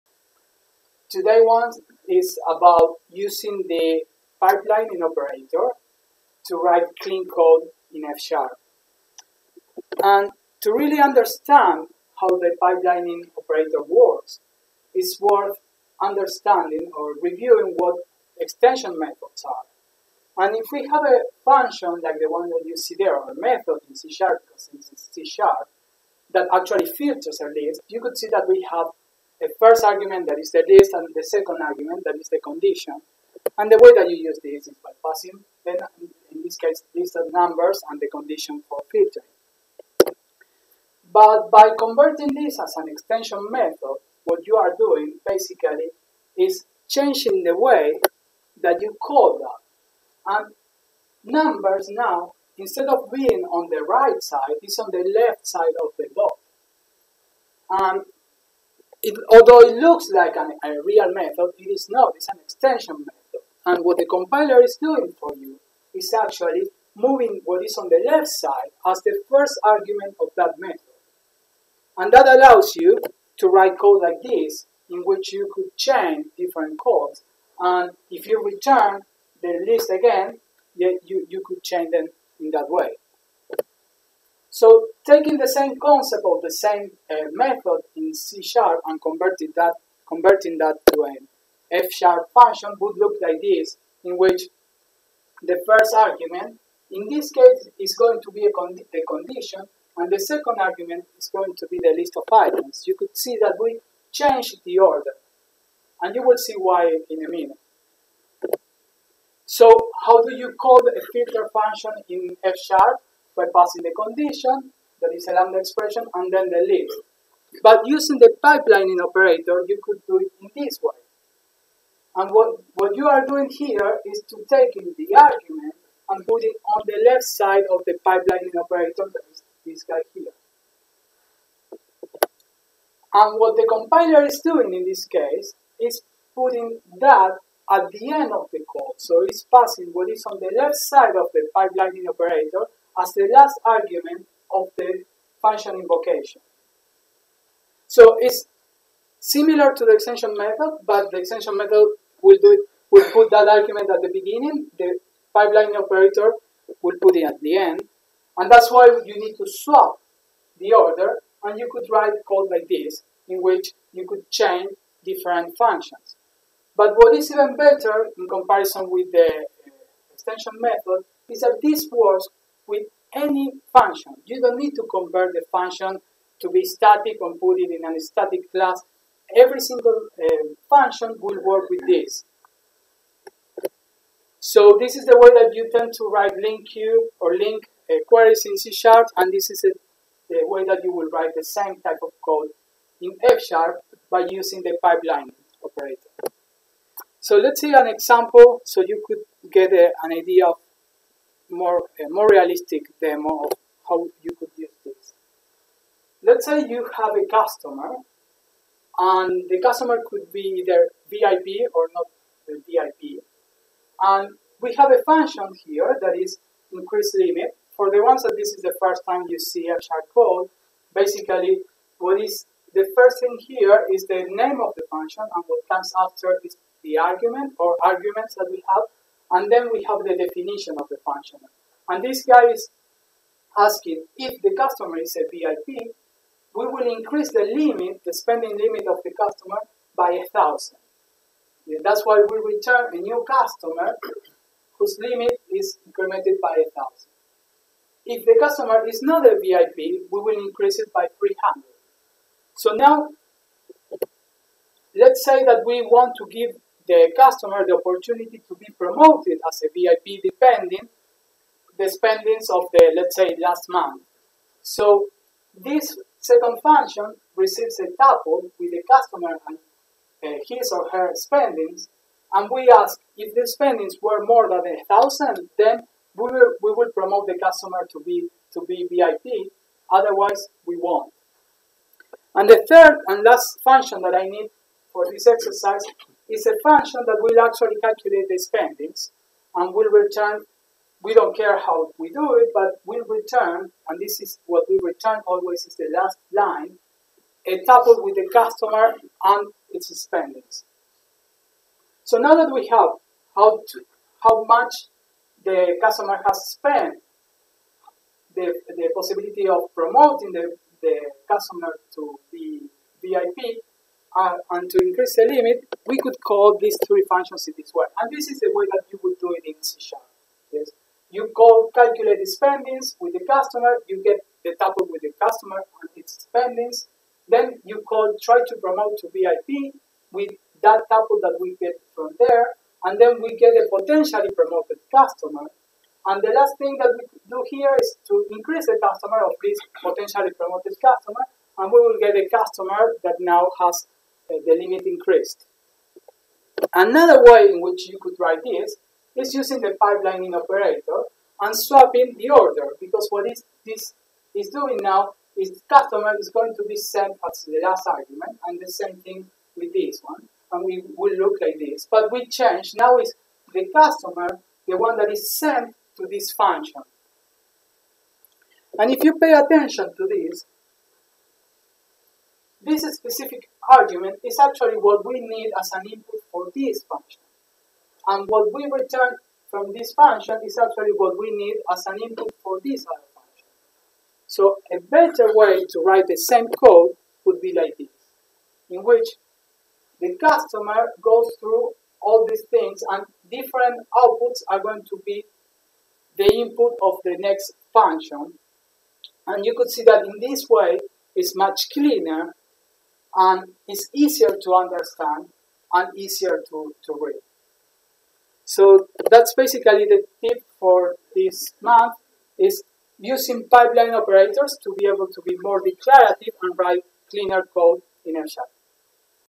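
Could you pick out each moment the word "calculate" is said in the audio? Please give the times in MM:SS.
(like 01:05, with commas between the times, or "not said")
04:47, 05:21.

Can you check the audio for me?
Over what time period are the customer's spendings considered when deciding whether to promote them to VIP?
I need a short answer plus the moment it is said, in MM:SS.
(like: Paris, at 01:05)
last month, at 04:23.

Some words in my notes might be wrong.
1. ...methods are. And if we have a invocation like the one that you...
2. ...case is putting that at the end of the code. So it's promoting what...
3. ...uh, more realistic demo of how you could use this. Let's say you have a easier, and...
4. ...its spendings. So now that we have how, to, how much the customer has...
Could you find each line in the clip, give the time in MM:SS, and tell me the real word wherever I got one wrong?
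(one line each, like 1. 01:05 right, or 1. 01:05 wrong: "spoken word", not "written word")
1. 00:18 wrong: "function", not "invocation"
2. 02:15 wrong: "passing", not "promoting"
3. 03:22 wrong: "customer", not "easier"
4. 04:59 right.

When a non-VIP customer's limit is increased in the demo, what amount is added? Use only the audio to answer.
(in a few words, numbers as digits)
300.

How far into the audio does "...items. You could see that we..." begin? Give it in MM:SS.
01:42.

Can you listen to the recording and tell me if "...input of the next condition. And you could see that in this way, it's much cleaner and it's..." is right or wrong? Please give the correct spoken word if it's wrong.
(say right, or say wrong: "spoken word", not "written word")
wrong: "function", not "condition".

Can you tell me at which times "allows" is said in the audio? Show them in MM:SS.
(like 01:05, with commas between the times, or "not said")
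01:12.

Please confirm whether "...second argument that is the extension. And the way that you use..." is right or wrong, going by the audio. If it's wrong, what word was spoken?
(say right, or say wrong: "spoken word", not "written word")
wrong: "condition", not "extension".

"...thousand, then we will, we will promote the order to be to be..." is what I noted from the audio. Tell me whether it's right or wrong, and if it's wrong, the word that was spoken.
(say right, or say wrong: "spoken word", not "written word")
wrong: "customer", not "order".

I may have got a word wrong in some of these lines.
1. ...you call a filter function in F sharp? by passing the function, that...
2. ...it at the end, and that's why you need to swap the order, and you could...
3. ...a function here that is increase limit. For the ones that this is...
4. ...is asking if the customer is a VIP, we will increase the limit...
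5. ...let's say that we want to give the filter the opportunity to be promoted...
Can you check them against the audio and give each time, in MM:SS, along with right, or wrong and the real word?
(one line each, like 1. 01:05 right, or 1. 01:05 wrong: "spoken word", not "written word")
1. 01:50 wrong: "condition", not "function"
2. 02:37 right
3. 03:34 right
4. 03:52 right
5. 04:14 wrong: "customer", not "filter".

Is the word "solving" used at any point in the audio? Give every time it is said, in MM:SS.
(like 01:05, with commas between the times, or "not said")
not said.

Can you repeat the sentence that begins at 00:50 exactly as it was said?
And numbers now, instead of being on the right side, is on the left side of the box.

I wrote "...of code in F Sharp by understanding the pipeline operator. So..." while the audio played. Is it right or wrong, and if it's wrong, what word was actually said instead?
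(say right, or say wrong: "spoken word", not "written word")
wrong: "using", not "understanding".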